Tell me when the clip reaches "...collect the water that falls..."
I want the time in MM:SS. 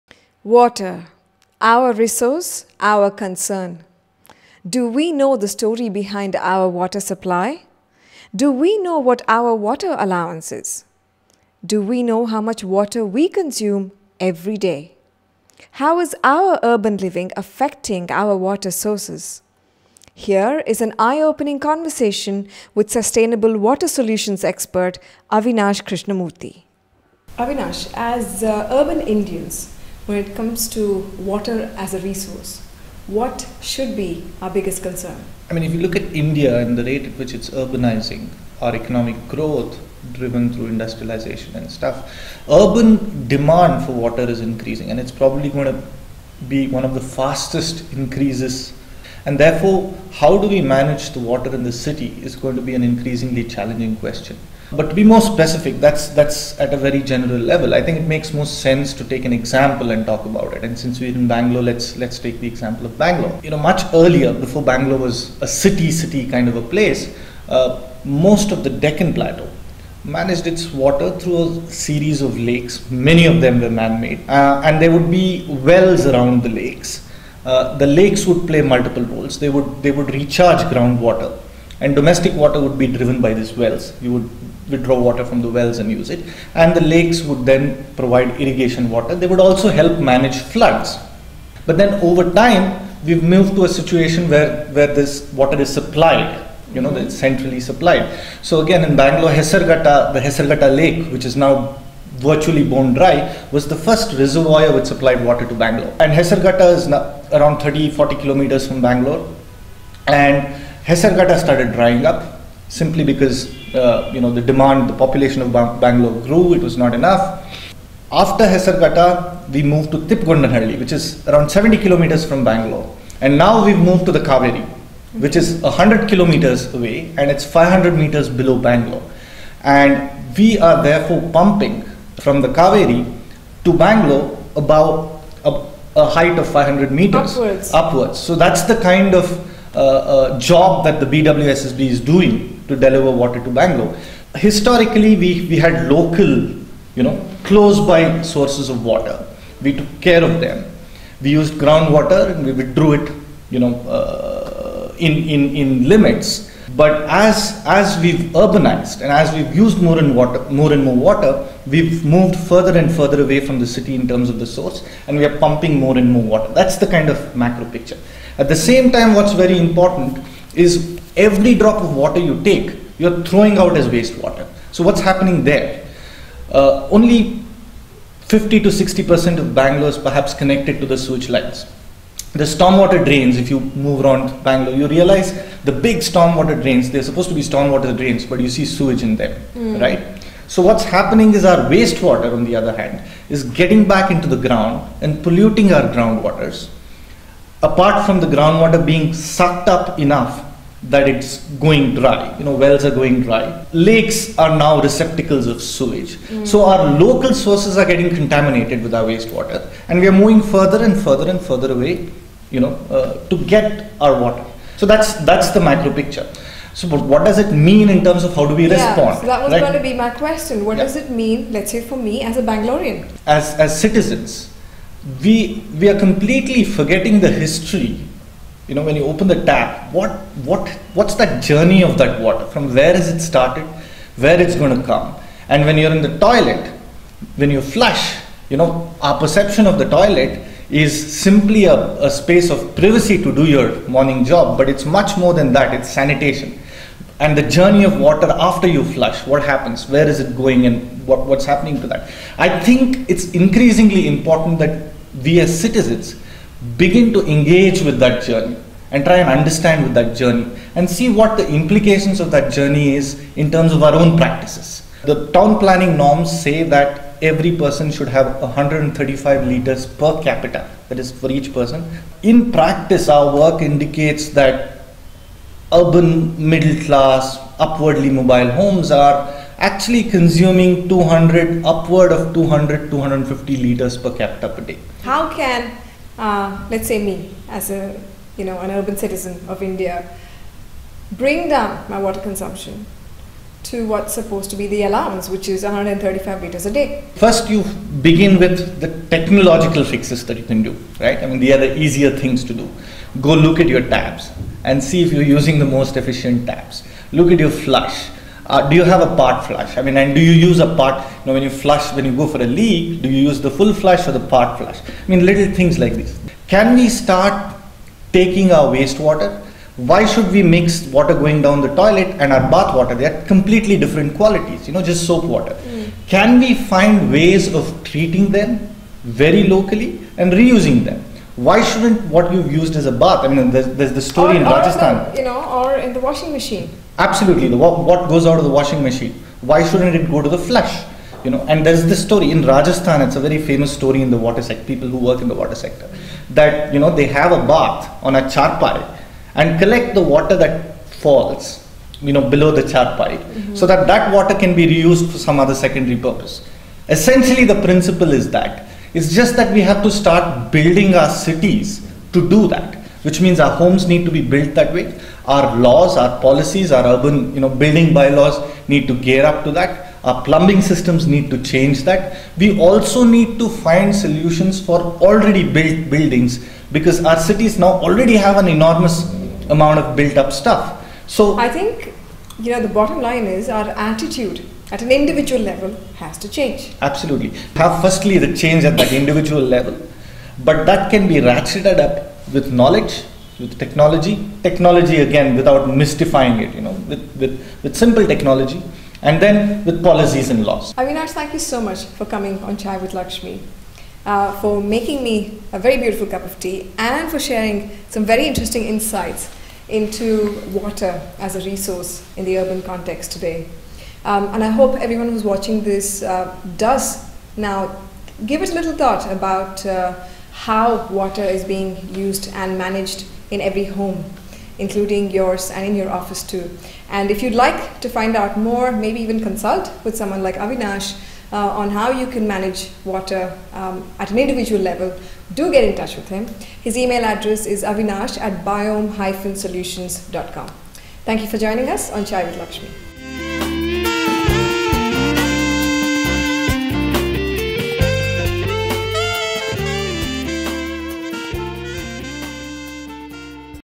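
05:49.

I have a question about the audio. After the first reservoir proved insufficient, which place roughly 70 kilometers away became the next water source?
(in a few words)
Tipgondanhalli.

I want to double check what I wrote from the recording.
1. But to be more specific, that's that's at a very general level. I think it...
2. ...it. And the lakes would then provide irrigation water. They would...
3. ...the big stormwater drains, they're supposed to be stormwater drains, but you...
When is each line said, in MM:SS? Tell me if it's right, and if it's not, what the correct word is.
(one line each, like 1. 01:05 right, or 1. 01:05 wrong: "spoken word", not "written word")
1. 00:54 right
2. 01:26 right
3. 03:05 right.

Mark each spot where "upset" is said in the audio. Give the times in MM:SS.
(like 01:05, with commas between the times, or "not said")
not said.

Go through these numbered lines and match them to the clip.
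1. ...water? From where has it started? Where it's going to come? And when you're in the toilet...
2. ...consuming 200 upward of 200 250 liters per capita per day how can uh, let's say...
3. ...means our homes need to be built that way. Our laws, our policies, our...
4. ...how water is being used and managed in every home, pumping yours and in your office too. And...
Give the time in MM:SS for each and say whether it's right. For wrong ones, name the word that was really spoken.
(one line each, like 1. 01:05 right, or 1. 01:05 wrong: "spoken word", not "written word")
1. 03:52 right
2. 04:40 right
3. 06:03 right
4. 07:00 wrong: "including", not "pumping".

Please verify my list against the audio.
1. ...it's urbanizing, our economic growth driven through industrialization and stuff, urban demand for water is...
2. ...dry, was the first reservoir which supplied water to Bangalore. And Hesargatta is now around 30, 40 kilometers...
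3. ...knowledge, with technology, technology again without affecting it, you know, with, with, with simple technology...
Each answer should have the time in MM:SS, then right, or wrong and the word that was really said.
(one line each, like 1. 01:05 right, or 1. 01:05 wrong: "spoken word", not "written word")
1. 00:37 right
2. 01:42 right
3. 06:32 wrong: "mystifying", not "affecting".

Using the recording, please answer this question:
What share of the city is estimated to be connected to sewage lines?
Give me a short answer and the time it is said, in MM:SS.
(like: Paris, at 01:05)
50 to 60%, at 02:58.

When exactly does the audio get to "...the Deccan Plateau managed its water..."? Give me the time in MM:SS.
01:08.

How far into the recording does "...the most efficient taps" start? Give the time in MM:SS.
05:05.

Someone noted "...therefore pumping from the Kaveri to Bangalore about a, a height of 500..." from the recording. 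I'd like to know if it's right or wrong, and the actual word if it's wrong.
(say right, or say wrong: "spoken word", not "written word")
right.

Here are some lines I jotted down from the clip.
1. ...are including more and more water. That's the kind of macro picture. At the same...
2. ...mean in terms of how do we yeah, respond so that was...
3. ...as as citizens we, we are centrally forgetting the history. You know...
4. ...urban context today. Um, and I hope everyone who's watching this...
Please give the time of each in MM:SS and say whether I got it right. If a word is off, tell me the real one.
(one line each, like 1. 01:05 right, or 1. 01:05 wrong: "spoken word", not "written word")
1. 02:45 wrong: "pumping", not "including"
2. 03:37 right
3. 03:43 wrong: "completely", not "centrally"
4. 06:52 right.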